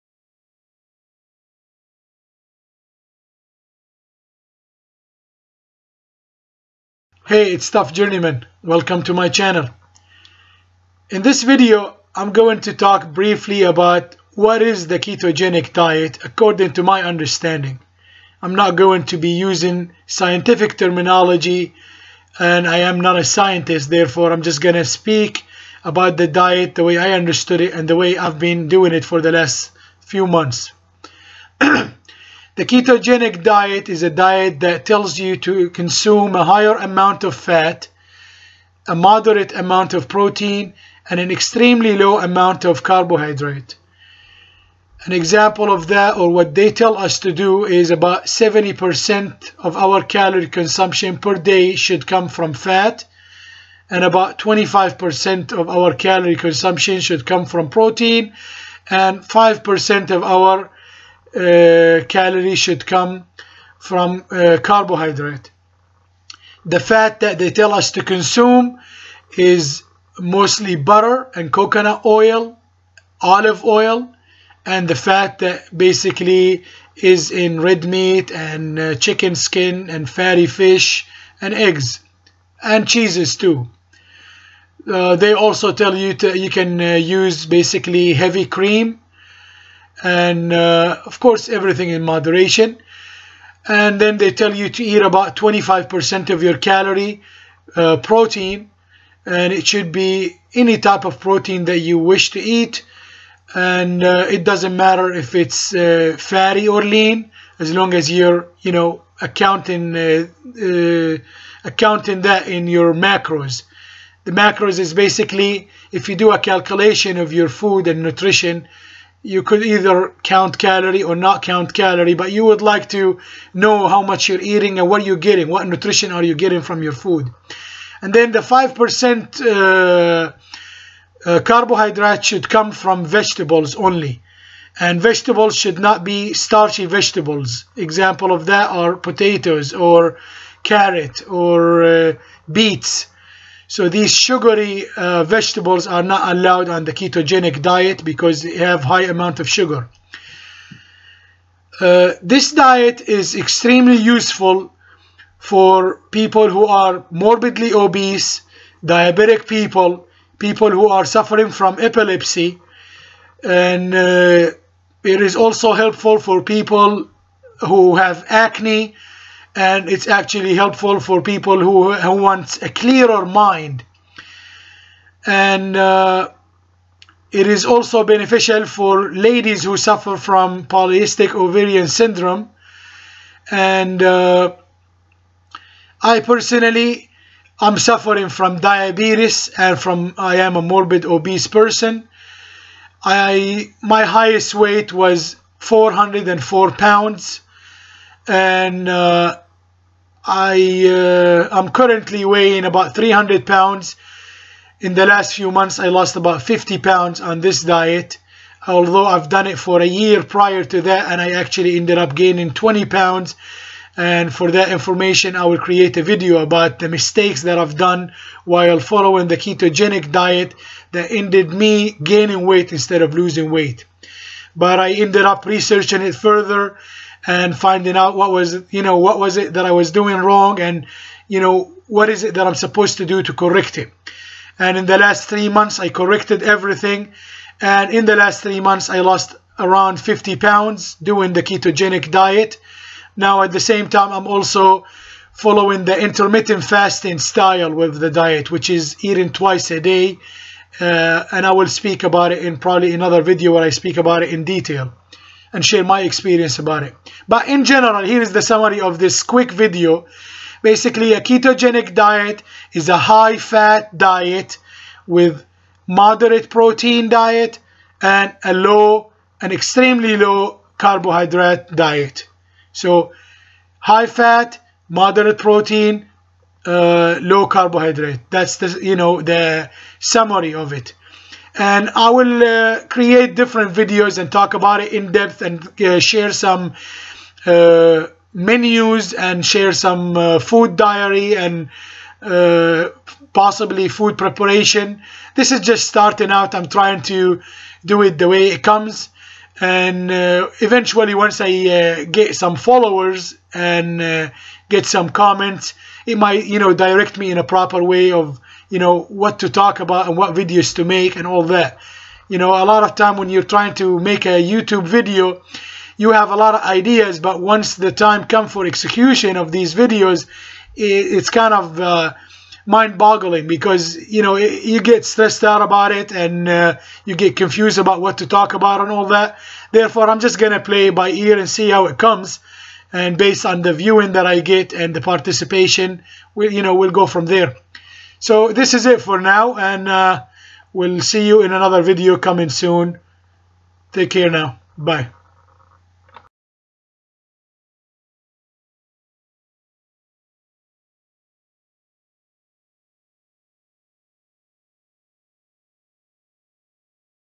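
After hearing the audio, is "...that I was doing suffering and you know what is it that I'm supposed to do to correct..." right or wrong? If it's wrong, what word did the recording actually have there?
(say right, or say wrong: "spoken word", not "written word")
wrong: "wrong", not "suffering".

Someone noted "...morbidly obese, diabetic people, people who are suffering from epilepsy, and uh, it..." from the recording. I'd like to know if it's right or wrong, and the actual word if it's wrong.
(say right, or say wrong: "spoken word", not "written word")
right.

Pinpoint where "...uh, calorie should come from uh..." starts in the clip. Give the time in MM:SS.
01:01.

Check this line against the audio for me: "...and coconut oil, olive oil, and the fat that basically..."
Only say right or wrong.
right.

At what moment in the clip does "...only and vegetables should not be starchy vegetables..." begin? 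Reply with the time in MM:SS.
02:13.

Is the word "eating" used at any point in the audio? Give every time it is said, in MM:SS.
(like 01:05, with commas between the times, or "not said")
02:04, 04:09.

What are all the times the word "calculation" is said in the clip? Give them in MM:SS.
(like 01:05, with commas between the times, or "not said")
01:56.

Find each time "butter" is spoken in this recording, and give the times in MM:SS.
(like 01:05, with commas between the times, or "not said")
01:10.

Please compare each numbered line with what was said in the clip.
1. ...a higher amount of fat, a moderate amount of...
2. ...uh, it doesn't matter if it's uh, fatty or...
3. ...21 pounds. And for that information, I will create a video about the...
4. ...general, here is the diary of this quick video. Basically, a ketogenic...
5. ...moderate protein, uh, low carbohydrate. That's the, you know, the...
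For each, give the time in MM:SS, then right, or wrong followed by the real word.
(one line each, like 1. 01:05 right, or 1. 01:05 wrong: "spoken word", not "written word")
1. 00:36 right
2. 01:44 right
3. 03:32 wrong: "20", not "21"
4. 04:17 wrong: "summary", not "diary"
5. 04:34 right.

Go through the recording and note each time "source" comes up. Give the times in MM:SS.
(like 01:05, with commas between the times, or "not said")
not said.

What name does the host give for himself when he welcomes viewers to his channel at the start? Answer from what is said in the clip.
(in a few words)
Tough Journeyman.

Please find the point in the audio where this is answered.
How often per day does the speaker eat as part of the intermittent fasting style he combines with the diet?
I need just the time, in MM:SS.
04:09.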